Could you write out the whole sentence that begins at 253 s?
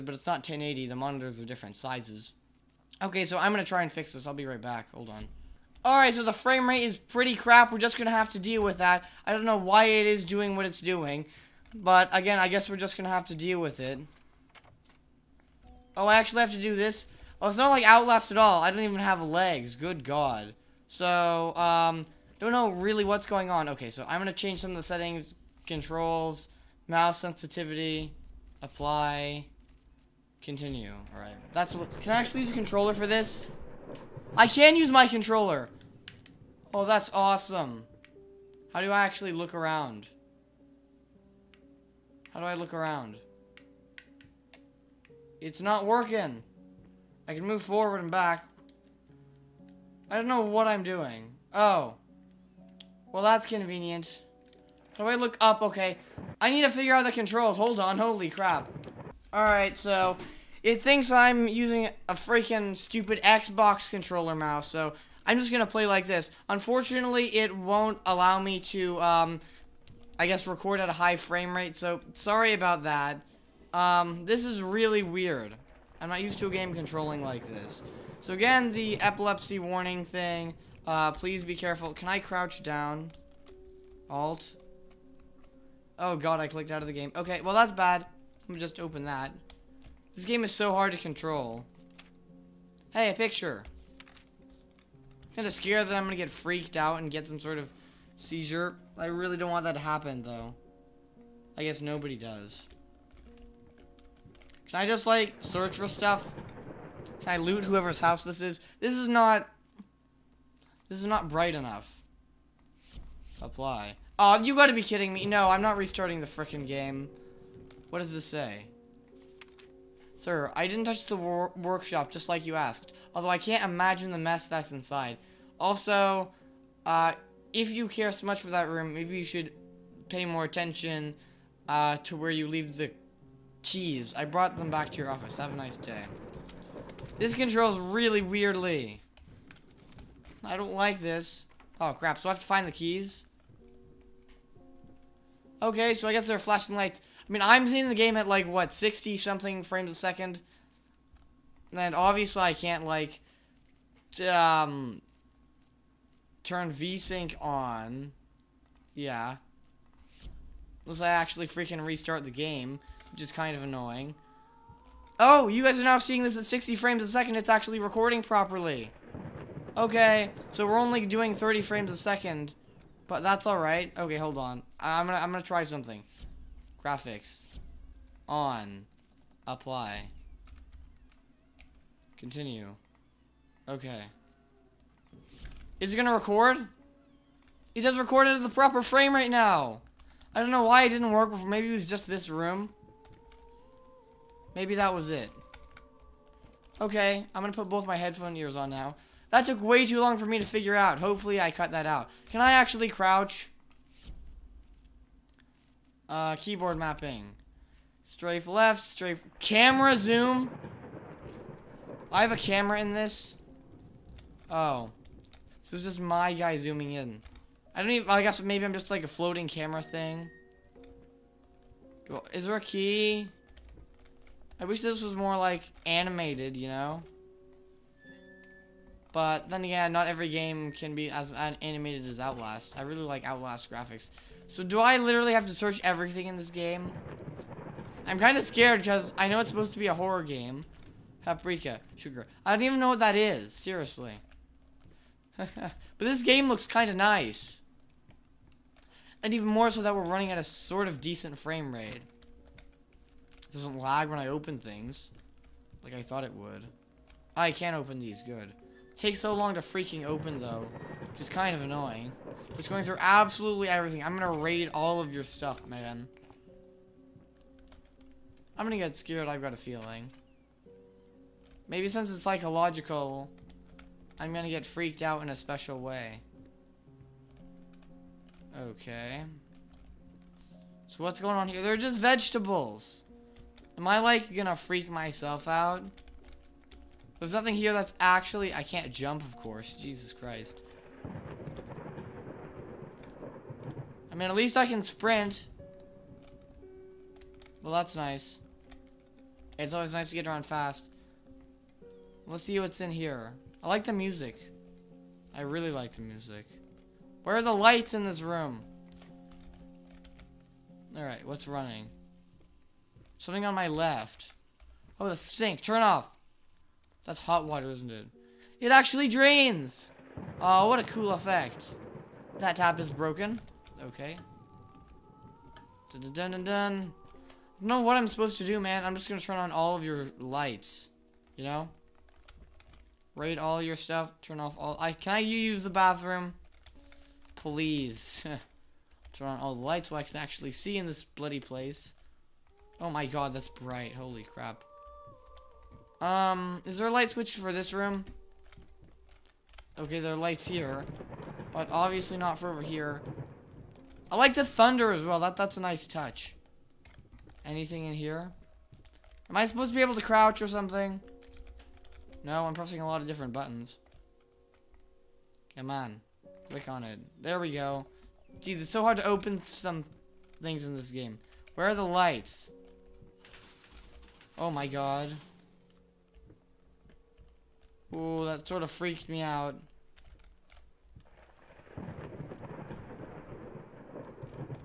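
It doesn't lag when I open things.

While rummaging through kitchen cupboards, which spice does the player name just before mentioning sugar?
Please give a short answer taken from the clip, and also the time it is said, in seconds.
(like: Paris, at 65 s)
Paprika, at 241 s.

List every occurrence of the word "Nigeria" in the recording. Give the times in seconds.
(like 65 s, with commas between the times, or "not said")
not said.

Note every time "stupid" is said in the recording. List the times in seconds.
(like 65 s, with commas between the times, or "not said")
62 s.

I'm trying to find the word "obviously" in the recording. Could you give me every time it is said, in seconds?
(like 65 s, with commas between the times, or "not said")
151 s, 351 s.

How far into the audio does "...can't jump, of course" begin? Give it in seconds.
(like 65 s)
288 s.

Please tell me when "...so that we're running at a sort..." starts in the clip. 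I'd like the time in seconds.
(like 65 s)
249 s.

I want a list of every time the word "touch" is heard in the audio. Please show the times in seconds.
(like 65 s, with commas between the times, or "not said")
120 s, 355 s.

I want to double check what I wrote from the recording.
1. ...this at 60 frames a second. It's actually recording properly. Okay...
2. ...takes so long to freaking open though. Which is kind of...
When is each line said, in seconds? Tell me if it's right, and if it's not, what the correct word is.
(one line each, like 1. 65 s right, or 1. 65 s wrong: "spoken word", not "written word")
1. 166 s right
2. 258 s right.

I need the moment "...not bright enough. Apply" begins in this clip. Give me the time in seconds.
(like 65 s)
111 s.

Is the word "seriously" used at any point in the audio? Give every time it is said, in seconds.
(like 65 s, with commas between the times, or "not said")
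243 s.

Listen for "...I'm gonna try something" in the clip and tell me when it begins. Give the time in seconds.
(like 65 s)
175 s.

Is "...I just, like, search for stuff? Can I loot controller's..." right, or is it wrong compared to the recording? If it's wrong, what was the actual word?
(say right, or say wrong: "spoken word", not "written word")
wrong: "whoever", not "controller".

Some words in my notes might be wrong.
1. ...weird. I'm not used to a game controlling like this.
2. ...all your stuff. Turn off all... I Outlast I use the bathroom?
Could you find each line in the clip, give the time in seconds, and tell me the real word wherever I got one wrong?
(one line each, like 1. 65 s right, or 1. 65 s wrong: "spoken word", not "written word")
1. 75 s right
2. 333 s wrong: "Can", not "Outlast".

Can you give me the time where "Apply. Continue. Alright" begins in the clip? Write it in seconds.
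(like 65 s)
28 s.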